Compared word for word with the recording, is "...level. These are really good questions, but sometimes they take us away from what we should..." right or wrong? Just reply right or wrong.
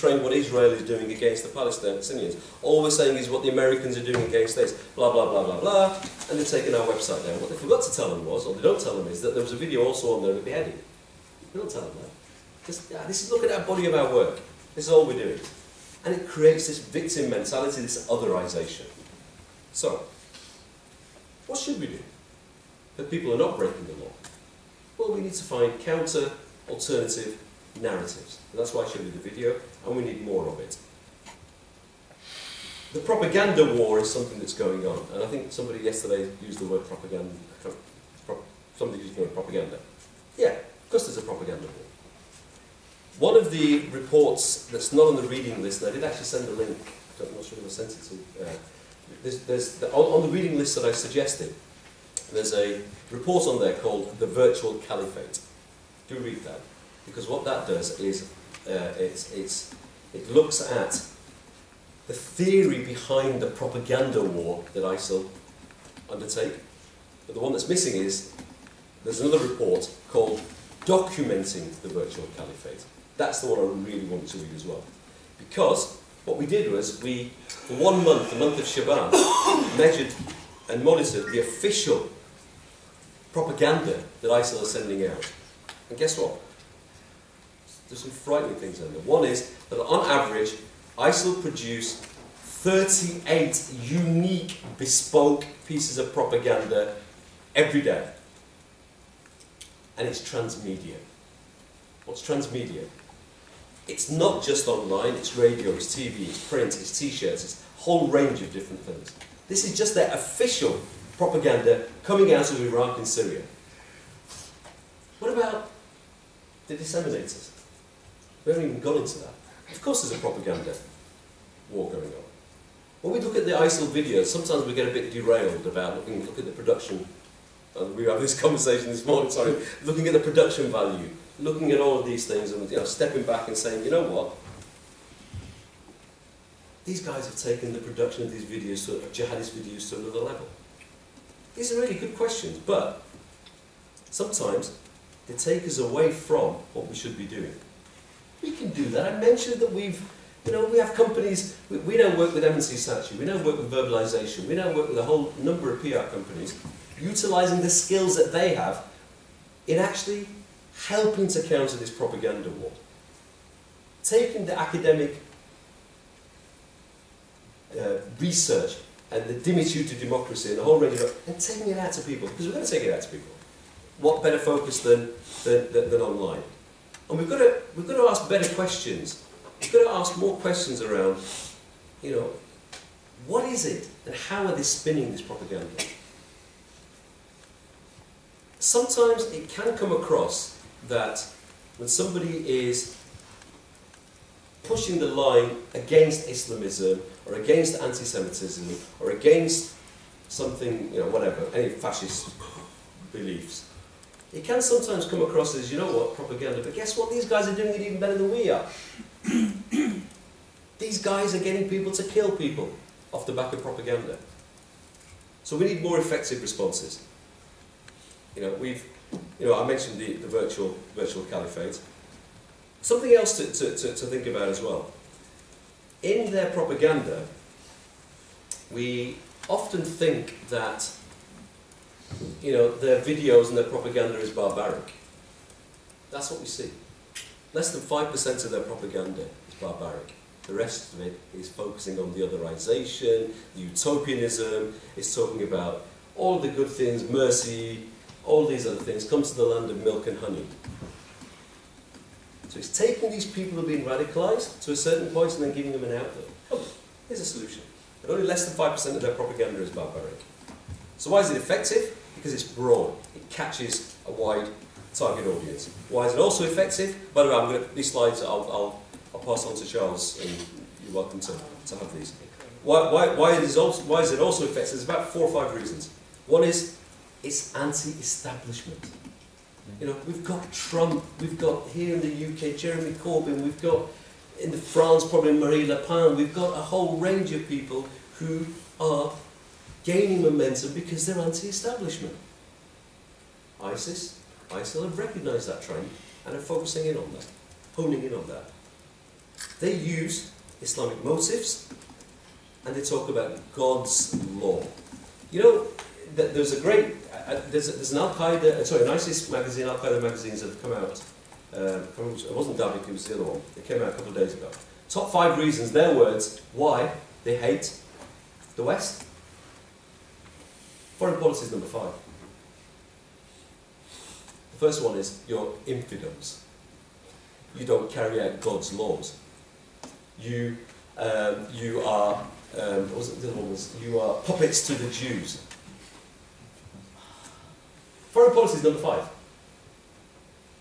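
right.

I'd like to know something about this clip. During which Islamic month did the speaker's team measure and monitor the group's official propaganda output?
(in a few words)
Shaban.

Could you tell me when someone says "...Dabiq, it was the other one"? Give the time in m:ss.
5:12.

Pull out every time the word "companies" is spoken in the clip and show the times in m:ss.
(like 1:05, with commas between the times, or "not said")
2:30, 2:36.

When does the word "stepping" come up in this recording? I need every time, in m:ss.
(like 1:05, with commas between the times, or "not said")
2:12.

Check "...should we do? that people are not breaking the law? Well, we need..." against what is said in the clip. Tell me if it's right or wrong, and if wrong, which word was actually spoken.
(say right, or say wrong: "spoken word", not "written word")
right.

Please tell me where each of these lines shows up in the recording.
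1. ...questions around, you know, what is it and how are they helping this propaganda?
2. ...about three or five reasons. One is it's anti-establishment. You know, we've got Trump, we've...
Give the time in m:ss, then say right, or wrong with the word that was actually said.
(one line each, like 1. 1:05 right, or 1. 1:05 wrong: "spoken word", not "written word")
1. 3:00 wrong: "spinning", not "helping"
2. 4:34 wrong: "four", not "three".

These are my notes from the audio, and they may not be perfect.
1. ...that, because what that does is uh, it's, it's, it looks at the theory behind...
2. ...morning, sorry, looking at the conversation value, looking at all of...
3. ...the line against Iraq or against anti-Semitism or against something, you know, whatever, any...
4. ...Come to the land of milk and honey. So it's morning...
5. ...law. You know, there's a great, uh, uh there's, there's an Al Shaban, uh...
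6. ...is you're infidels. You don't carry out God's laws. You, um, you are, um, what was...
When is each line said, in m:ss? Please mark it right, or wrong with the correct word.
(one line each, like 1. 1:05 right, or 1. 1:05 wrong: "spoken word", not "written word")
1. 0:56 right
2. 2:09 wrong: "production", not "conversation"
3. 3:14 wrong: "Islamism", not "Iraq"
4. 4:09 wrong: "taking", not "morning"
5. 5:04 wrong: "Qaeda", not "Shaban"
6. 5:24 right.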